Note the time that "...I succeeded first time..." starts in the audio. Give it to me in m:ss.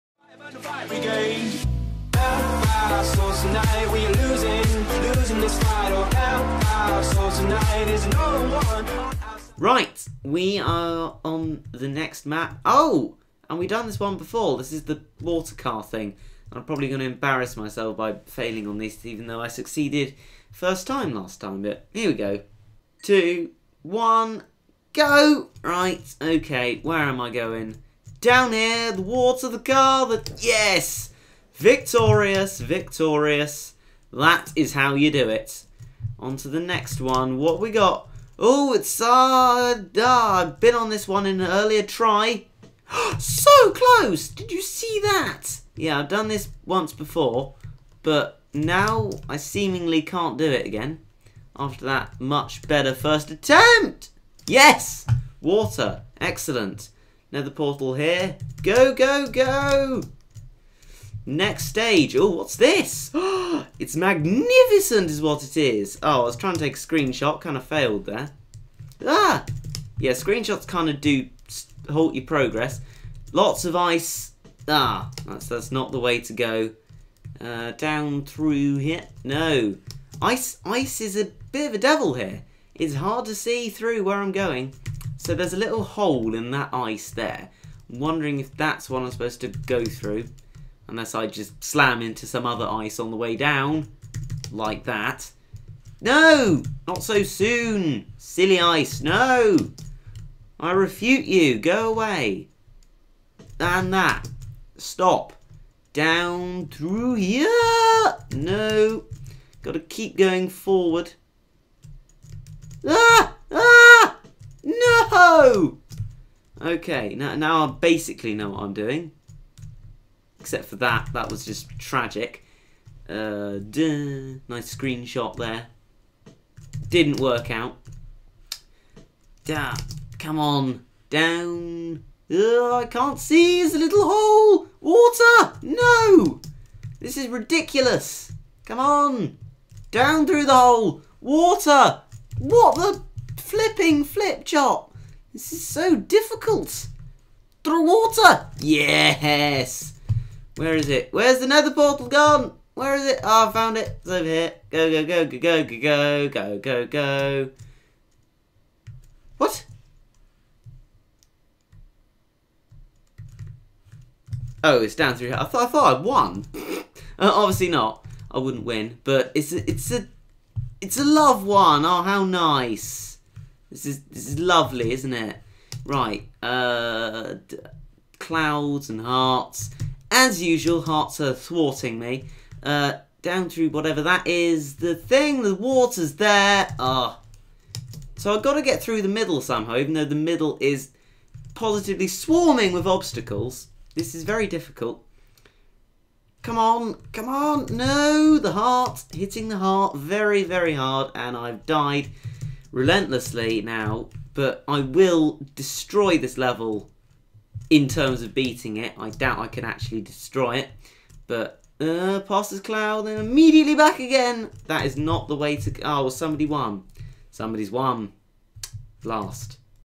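0:19.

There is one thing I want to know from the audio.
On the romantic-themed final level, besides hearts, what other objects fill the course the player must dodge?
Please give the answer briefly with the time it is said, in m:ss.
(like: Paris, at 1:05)
Clouds, at 2:58.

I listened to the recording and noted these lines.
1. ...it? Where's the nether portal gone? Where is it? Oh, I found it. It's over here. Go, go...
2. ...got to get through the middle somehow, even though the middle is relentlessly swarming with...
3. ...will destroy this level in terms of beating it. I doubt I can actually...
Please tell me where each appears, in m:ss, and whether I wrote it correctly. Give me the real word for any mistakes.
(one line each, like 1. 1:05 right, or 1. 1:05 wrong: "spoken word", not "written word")
1. 2:30 right
2. 3:08 wrong: "positively", not "relentlessly"
3. 3:24 right.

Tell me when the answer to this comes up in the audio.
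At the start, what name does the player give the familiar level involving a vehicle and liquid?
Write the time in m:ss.
0:15.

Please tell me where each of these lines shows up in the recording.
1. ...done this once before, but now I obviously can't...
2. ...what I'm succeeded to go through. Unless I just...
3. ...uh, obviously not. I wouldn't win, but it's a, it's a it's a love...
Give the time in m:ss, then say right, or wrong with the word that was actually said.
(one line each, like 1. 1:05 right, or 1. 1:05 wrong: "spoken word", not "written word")
1. 0:46 wrong: "seemingly", not "obviously"
2. 1:28 wrong: "supposed", not "succeeded"
3. 2:47 right.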